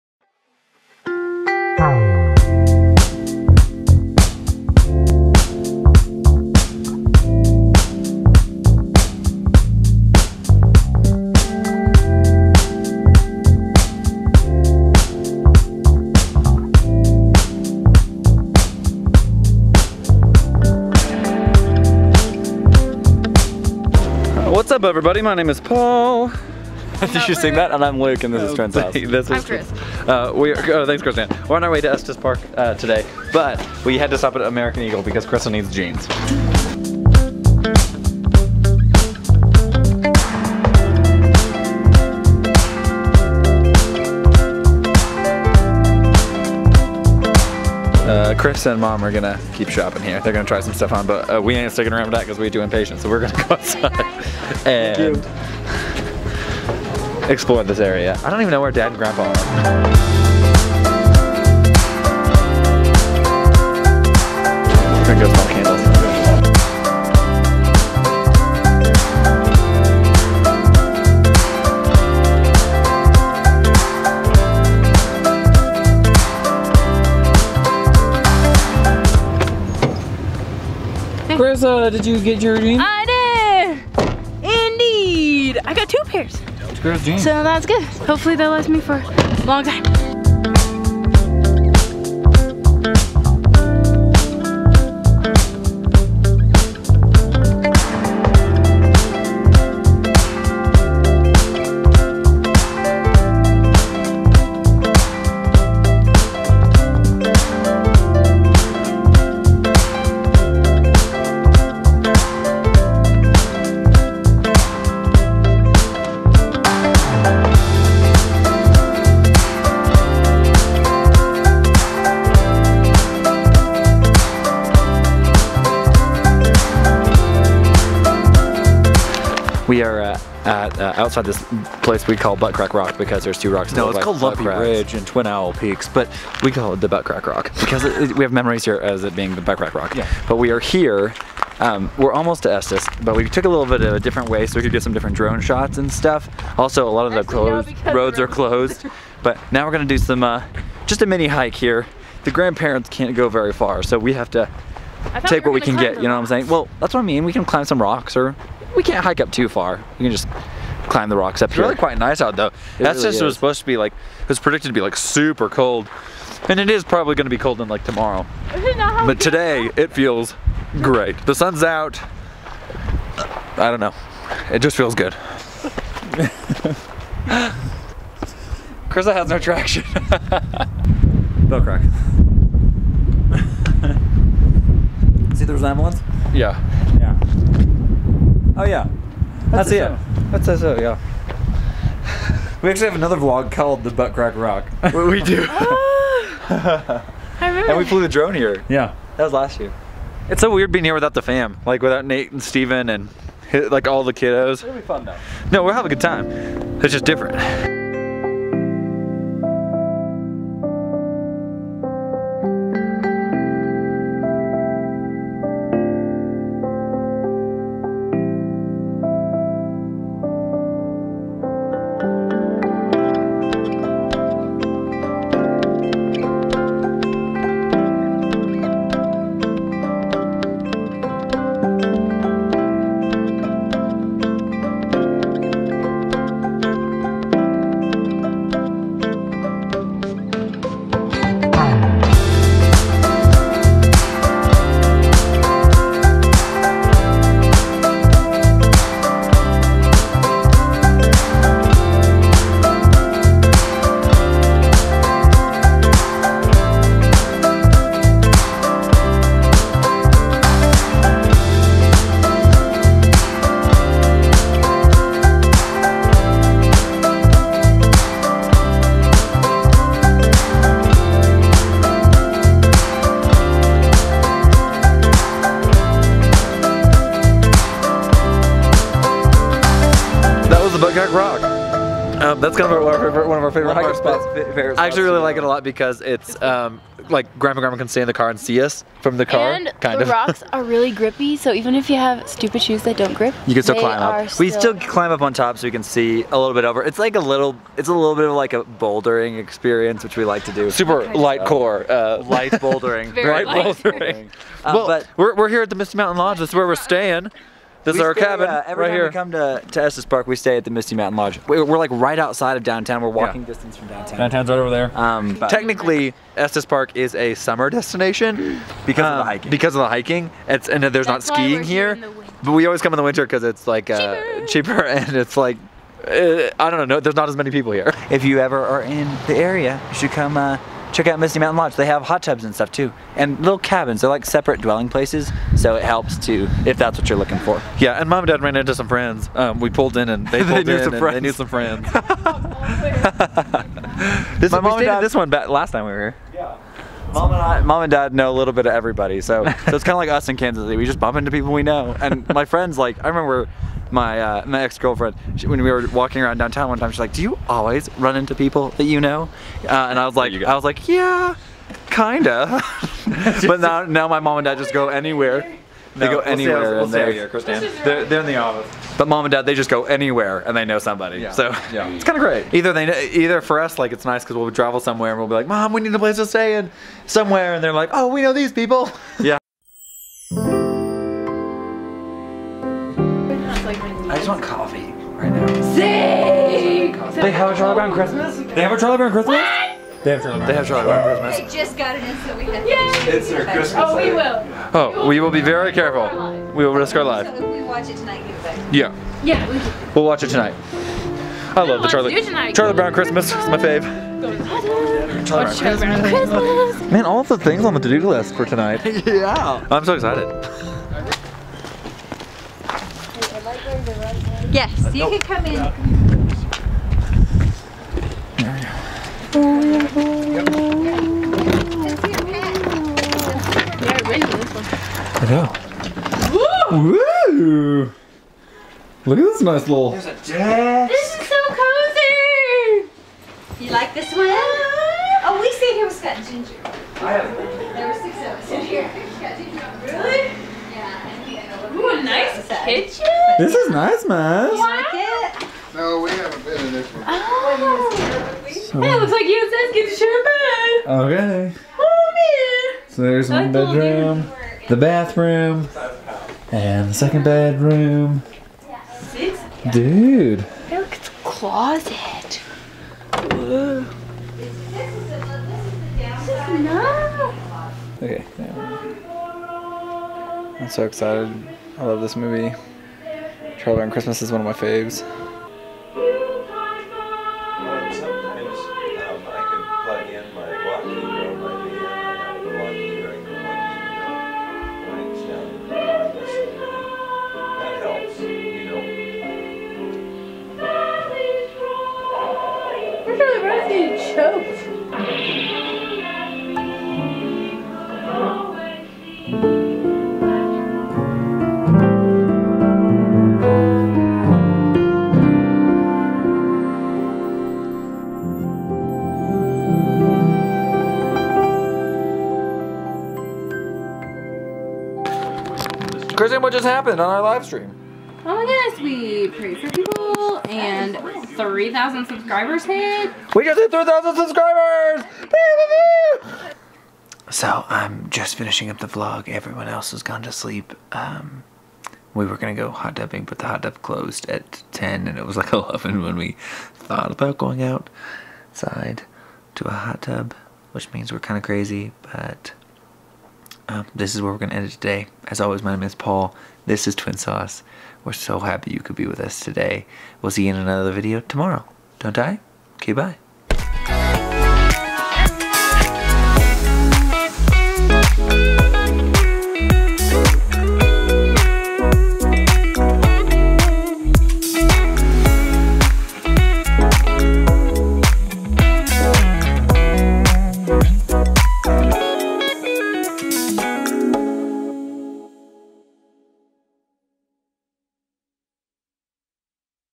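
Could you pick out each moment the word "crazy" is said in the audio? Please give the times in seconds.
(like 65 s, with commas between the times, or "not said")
541 s.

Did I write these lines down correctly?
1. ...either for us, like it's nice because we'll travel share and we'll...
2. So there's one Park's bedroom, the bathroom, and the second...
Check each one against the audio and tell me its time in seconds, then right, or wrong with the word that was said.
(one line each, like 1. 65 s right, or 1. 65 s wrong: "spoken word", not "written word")
1. 372 s wrong: "somewhere", not "share"
2. 452 s wrong: "That", not "Park".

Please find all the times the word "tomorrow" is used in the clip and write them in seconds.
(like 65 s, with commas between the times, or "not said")
167 s, 551 s.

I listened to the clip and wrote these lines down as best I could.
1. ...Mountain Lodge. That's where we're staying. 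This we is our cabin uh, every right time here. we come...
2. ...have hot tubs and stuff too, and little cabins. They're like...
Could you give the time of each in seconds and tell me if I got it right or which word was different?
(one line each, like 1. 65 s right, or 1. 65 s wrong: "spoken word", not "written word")
1. 305 s right
2. 331 s right.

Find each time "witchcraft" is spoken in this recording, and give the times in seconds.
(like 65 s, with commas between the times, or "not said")
not said.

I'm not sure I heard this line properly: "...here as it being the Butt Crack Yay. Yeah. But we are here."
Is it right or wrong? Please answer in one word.
wrong.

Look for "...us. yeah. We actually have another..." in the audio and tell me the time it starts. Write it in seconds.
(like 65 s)
190 s.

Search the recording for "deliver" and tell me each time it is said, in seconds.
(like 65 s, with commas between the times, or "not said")
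not said.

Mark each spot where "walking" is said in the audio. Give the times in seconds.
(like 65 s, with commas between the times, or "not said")
313 s, 355 s.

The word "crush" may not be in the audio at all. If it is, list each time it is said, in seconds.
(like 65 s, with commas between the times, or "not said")
not said.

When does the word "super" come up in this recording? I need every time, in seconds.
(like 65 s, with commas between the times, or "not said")
164 s, 300 s.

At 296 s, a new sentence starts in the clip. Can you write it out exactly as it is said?
It's like a little, it's a little bit of like a bouldering experience, which we like to do.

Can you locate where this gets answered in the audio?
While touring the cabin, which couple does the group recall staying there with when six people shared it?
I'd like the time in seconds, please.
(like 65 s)
435 s.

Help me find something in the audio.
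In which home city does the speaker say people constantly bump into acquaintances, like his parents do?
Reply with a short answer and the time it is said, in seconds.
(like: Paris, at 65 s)
Kansas City, at 350 s.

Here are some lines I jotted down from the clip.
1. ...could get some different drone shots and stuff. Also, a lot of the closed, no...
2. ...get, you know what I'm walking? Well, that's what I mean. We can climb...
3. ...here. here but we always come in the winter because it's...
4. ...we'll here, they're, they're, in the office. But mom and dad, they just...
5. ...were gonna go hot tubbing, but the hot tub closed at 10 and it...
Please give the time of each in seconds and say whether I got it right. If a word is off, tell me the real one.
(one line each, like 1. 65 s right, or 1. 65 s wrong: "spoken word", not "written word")
1. 144 s right
2. 155 s wrong: "saying", not "walking"
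3. 321 s right
4. 367 s right
5. 532 s right.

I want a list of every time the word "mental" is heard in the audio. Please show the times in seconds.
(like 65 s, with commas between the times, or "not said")
not said.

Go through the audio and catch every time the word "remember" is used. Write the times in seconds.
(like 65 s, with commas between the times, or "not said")
197 s, 353 s.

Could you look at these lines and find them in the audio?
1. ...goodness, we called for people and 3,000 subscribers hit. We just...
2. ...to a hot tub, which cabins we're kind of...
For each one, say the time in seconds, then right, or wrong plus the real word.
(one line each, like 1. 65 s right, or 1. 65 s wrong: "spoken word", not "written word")
1. 518 s wrong: "prayed", not "called"
2. 539 s wrong: "means", not "cabins".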